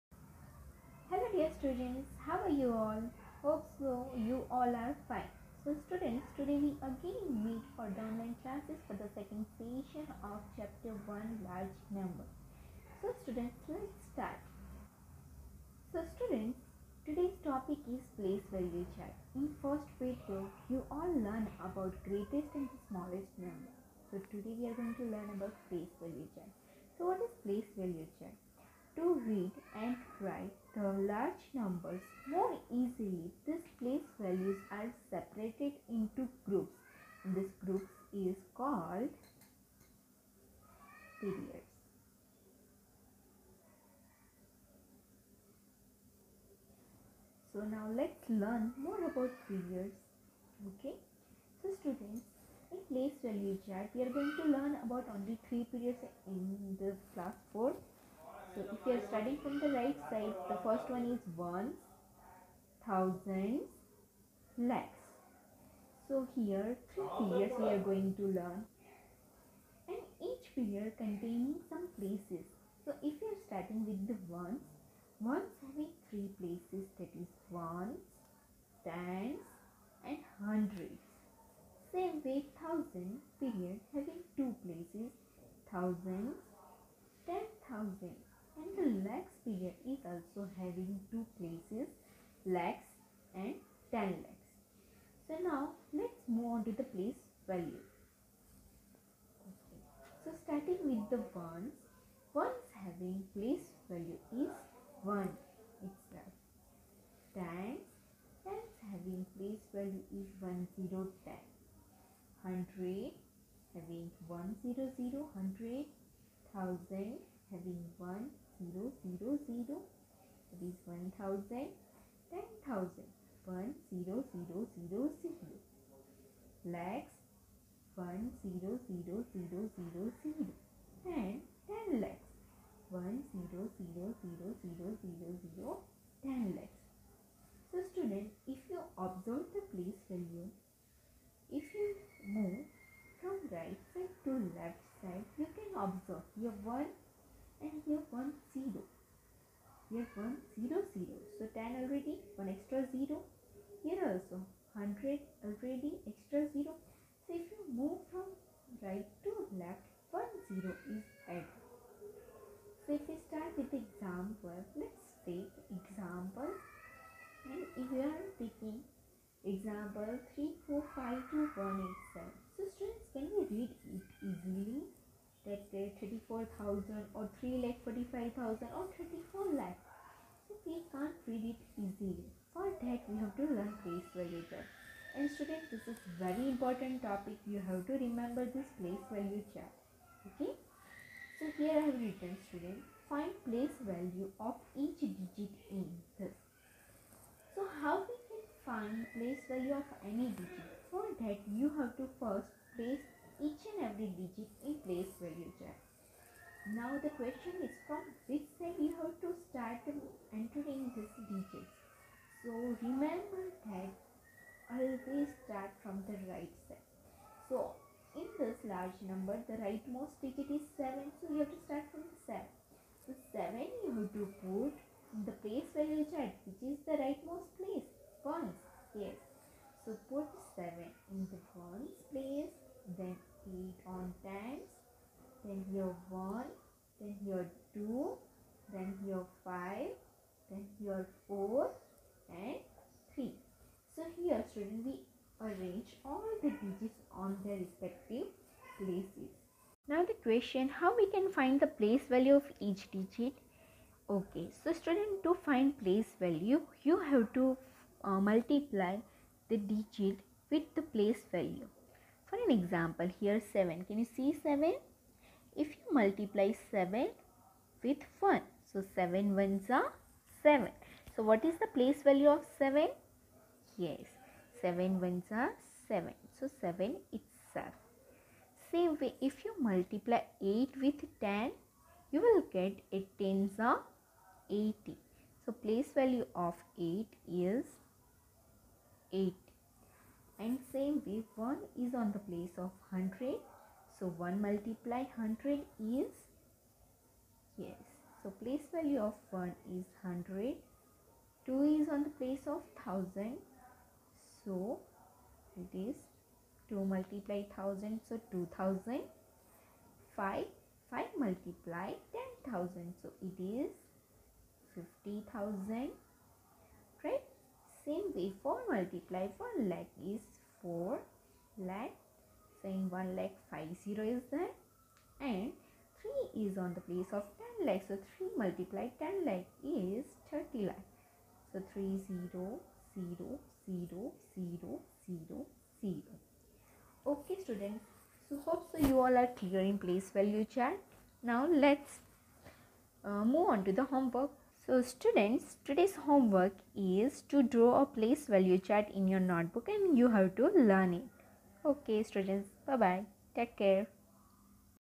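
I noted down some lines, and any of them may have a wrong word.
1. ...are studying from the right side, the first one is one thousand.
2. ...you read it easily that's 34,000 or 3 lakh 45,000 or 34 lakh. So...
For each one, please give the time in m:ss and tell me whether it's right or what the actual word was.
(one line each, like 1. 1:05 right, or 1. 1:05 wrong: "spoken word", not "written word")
1. 0:58 right
2. 2:53 right.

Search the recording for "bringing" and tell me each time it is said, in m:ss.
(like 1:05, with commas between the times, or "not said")
not said.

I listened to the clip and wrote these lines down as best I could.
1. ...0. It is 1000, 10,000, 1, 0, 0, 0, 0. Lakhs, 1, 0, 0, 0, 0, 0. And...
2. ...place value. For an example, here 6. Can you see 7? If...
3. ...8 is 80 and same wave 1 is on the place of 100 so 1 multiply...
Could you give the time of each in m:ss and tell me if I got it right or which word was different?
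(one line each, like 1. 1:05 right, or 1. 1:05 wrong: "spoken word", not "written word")
1. 1:59 right
2. 4:20 wrong: "7", not "6"
3. 4:46 right.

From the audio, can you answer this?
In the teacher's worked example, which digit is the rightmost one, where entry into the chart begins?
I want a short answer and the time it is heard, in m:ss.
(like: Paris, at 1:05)
7, at 3:39.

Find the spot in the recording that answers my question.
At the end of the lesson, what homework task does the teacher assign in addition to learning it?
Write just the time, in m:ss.
5:47.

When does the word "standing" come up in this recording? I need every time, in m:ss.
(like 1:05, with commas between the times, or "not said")
not said.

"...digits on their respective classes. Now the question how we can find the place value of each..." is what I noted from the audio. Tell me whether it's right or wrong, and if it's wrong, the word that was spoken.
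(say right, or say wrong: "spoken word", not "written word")
wrong: "places", not "classes".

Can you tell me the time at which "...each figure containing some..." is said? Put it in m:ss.
1:10.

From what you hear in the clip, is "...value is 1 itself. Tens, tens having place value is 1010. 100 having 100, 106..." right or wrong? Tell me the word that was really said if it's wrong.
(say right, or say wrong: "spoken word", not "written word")
wrong: "100", not "106".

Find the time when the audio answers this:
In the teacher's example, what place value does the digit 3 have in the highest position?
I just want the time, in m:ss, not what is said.
5:30.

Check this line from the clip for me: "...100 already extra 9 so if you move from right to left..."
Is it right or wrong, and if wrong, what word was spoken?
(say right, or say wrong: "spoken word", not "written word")
wrong: "0", not "9".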